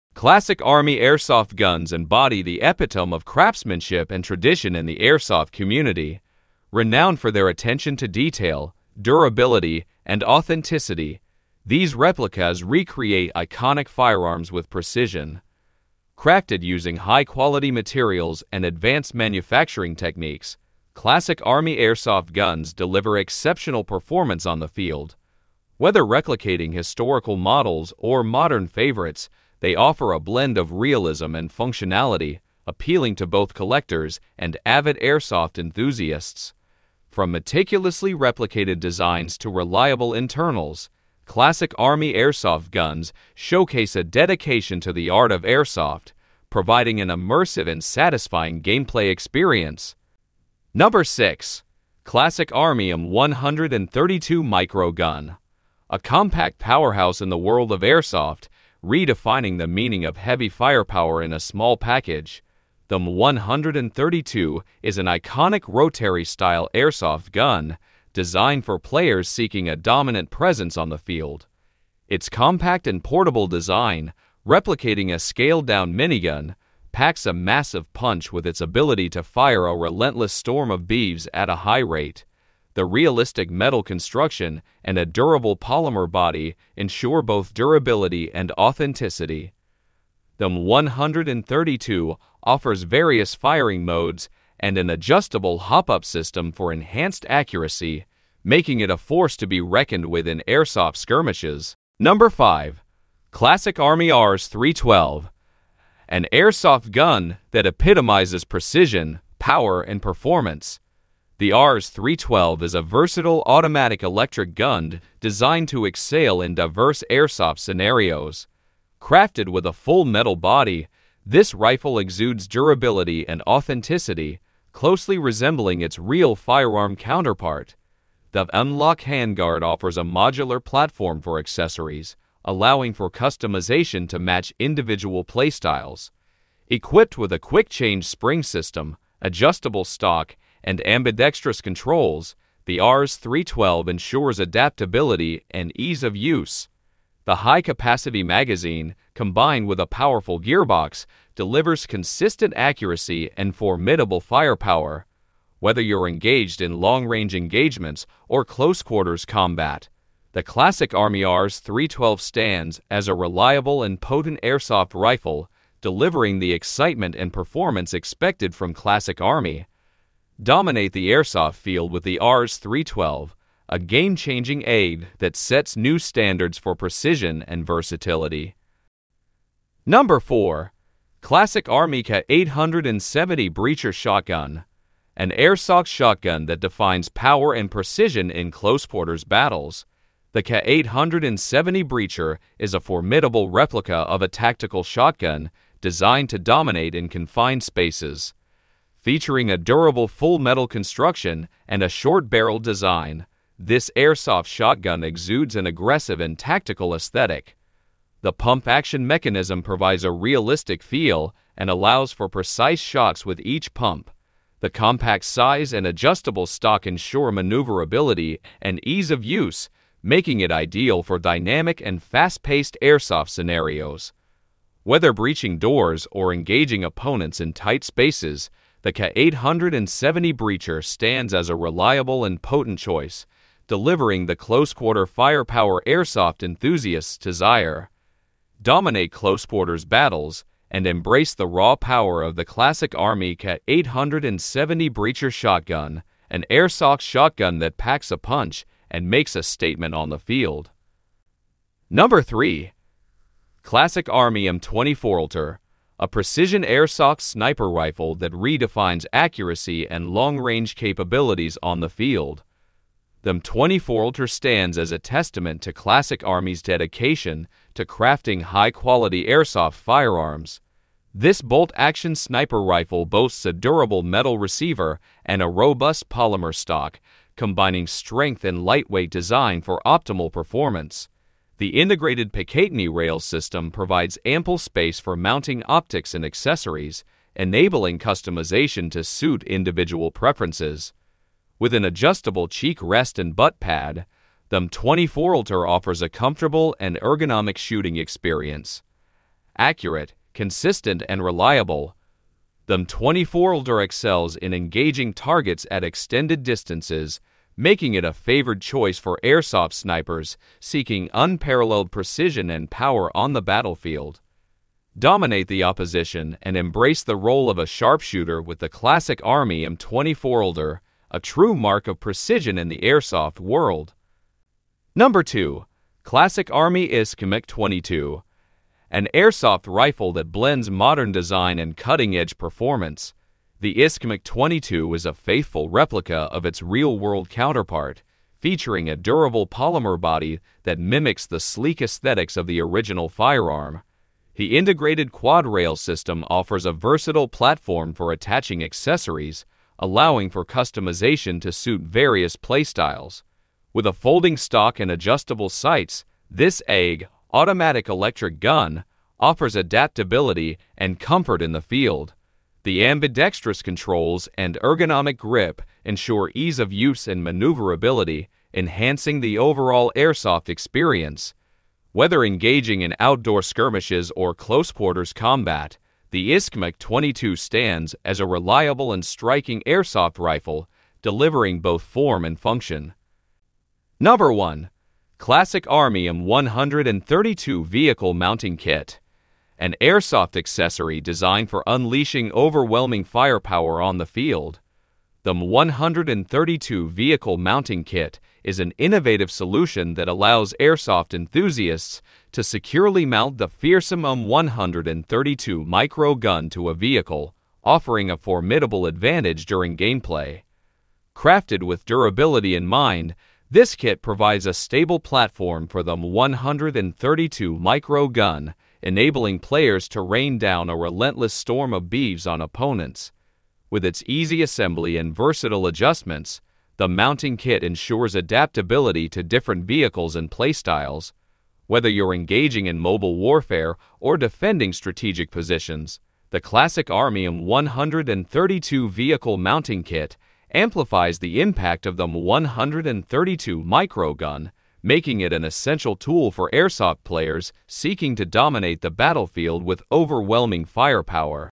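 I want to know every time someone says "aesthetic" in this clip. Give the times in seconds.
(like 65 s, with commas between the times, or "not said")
206 s, 341 s.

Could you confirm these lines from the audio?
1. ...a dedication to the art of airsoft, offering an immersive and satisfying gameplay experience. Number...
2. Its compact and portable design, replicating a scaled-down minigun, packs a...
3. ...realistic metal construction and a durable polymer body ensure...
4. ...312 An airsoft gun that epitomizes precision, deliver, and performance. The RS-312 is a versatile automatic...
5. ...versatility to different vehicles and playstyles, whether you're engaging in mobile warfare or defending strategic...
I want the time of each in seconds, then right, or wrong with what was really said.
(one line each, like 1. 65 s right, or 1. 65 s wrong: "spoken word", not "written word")
1. 43 s wrong: "providing", not "offering"
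2. 72 s right
3. 82 s right
4. 104 s wrong: "power", not "deliver"
5. 428 s wrong: "adaptability", not "versatility".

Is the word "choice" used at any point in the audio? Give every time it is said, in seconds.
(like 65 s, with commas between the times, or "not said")
232 s, 308 s.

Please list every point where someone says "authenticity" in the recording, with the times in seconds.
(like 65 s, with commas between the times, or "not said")
10 s, 88 s, 123 s.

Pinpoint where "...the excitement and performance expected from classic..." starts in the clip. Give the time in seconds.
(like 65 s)
166 s.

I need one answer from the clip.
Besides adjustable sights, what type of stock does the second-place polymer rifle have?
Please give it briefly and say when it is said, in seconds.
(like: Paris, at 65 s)
folding stock, at 353 s.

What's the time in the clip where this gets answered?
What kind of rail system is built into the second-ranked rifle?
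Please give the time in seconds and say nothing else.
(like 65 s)
345 s.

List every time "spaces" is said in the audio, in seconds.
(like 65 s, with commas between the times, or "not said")
197 s, 227 s, 284 s.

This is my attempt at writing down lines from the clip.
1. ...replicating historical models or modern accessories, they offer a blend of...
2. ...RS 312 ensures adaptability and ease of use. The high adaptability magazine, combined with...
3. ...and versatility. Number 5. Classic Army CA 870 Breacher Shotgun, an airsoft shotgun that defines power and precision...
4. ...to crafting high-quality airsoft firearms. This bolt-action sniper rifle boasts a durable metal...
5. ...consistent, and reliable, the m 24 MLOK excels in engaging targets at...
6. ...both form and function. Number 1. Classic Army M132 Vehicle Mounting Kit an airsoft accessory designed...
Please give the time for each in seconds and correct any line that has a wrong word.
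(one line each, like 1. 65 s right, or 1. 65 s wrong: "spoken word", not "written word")
1. 26 s wrong: "favorites", not "accessories"
2. 142 s wrong: "capacity", not "adaptability"
3. 177 s wrong: "4", not "5"
4. 267 s right
5. 300 s wrong: "LTR", not "MLOK"
6. 381 s right.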